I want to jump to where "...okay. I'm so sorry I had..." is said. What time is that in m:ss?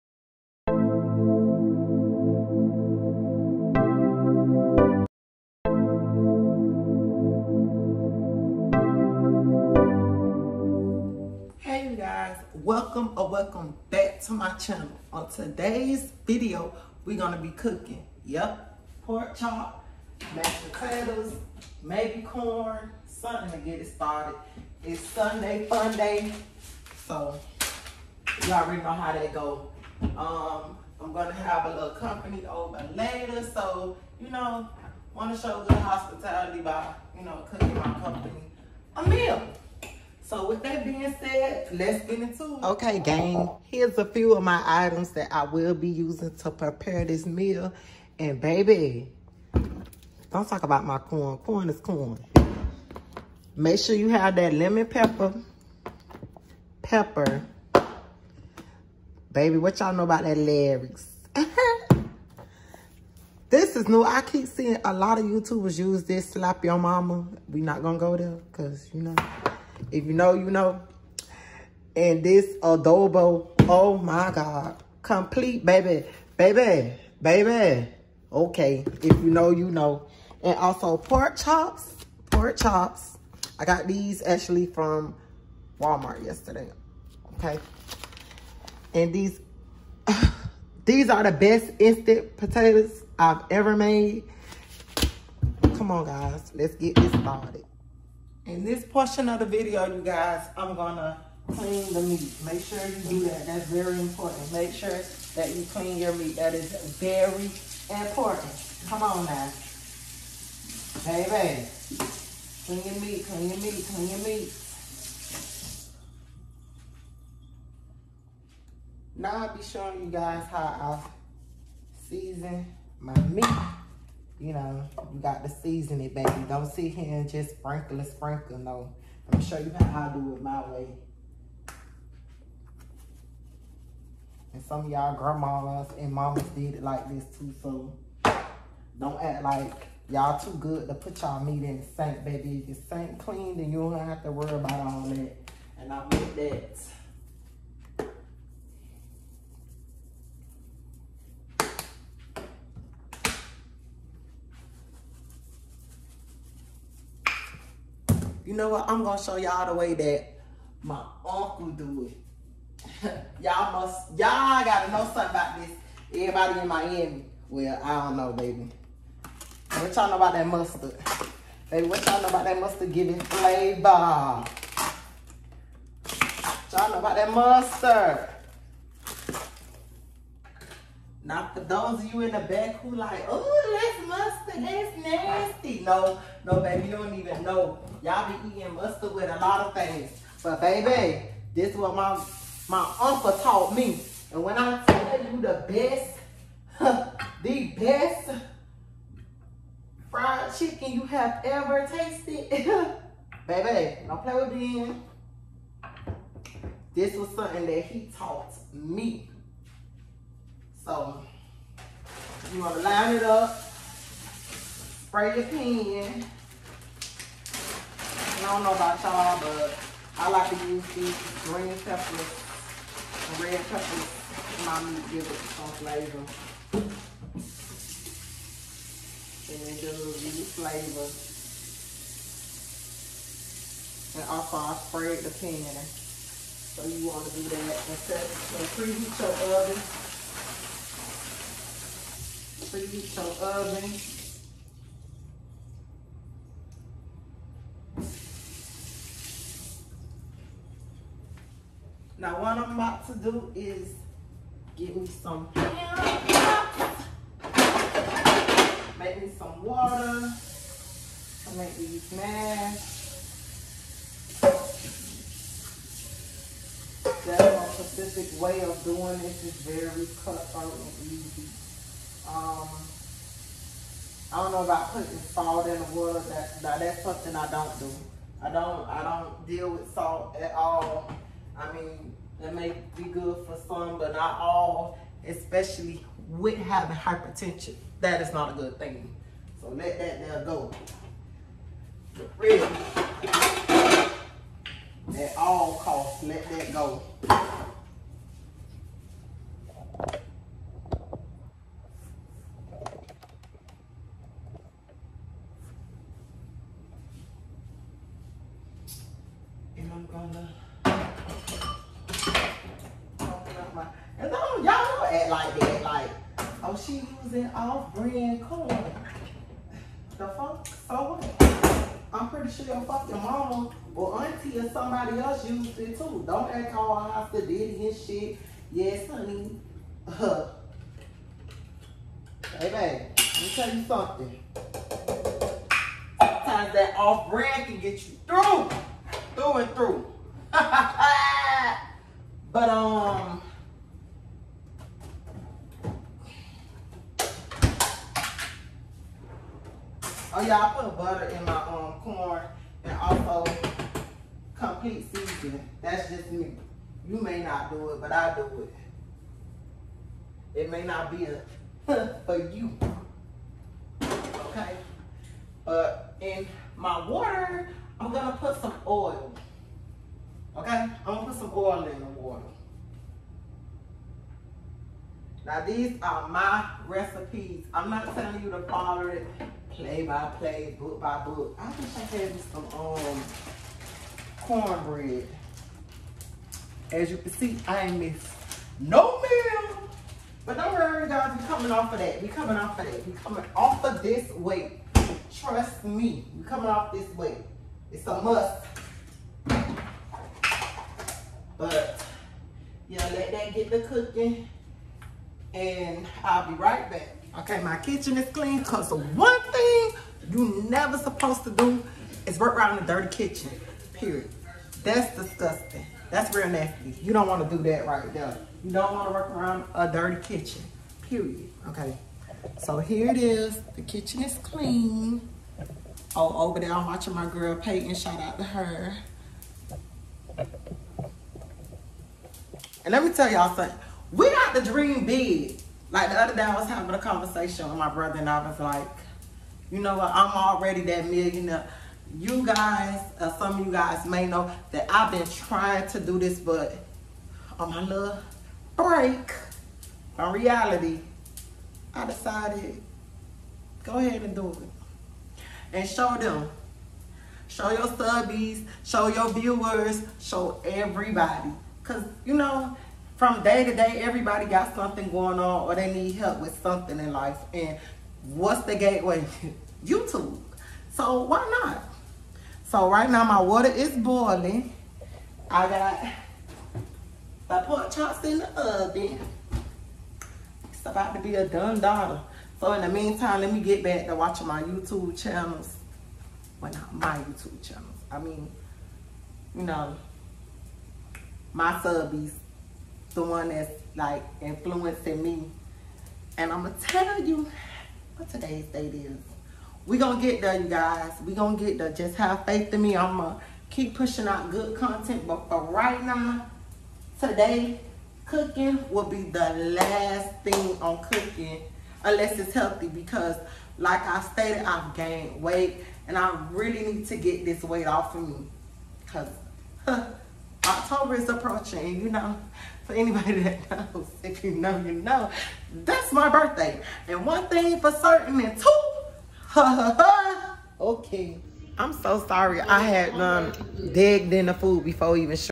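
8:50.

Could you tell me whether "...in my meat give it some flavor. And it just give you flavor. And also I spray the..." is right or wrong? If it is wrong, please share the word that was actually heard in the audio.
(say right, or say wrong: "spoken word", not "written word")
right.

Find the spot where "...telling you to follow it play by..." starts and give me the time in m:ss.
6:18.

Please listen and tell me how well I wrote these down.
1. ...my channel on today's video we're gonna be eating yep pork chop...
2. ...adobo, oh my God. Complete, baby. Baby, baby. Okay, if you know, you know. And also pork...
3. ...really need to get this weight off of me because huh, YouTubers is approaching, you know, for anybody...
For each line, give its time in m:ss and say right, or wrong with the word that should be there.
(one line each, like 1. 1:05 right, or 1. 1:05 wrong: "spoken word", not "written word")
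1. 0:14 wrong: "cooking", not "eating"
2. 1:12 right
3. 8:36 wrong: "October", not "YouTubers".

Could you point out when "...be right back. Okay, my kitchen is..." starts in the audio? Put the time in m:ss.
6:46.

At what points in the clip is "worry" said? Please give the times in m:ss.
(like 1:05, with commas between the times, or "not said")
2:24, 6:30.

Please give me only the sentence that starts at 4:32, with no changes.
Um, I don't know about putting salt in the water.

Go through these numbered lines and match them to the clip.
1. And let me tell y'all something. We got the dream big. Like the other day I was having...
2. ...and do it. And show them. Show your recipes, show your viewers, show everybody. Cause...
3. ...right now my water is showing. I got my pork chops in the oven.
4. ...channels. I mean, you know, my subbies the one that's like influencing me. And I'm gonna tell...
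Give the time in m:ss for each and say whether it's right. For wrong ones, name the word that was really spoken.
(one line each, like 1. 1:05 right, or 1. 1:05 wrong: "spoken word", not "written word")
1. 7:12 right
2. 7:34 wrong: "subbies", not "recipes"
3. 7:52 wrong: "boiling", not "showing"
4. 8:07 right.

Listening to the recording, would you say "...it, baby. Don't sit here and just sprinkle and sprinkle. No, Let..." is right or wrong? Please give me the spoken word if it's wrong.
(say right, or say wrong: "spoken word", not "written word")
right.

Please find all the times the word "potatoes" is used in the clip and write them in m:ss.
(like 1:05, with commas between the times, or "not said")
0:20, 1:32.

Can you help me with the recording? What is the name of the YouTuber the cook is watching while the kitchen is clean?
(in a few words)
Peyton.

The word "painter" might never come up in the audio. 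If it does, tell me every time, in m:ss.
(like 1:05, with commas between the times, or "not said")
not said.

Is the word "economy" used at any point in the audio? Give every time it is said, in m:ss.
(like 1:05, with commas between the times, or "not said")
not said.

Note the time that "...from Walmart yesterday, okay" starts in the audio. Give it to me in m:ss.
1:24.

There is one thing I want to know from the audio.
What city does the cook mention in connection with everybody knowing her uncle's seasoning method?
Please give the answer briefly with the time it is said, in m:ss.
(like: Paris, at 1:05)
Miami, at 2:46.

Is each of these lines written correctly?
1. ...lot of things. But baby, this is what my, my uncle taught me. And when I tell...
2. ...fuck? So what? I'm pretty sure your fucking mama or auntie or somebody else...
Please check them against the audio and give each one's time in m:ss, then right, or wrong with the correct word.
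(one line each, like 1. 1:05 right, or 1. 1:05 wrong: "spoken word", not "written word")
1. 3:09 right
2. 5:20 right.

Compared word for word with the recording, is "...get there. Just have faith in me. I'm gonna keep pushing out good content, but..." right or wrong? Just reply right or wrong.
right.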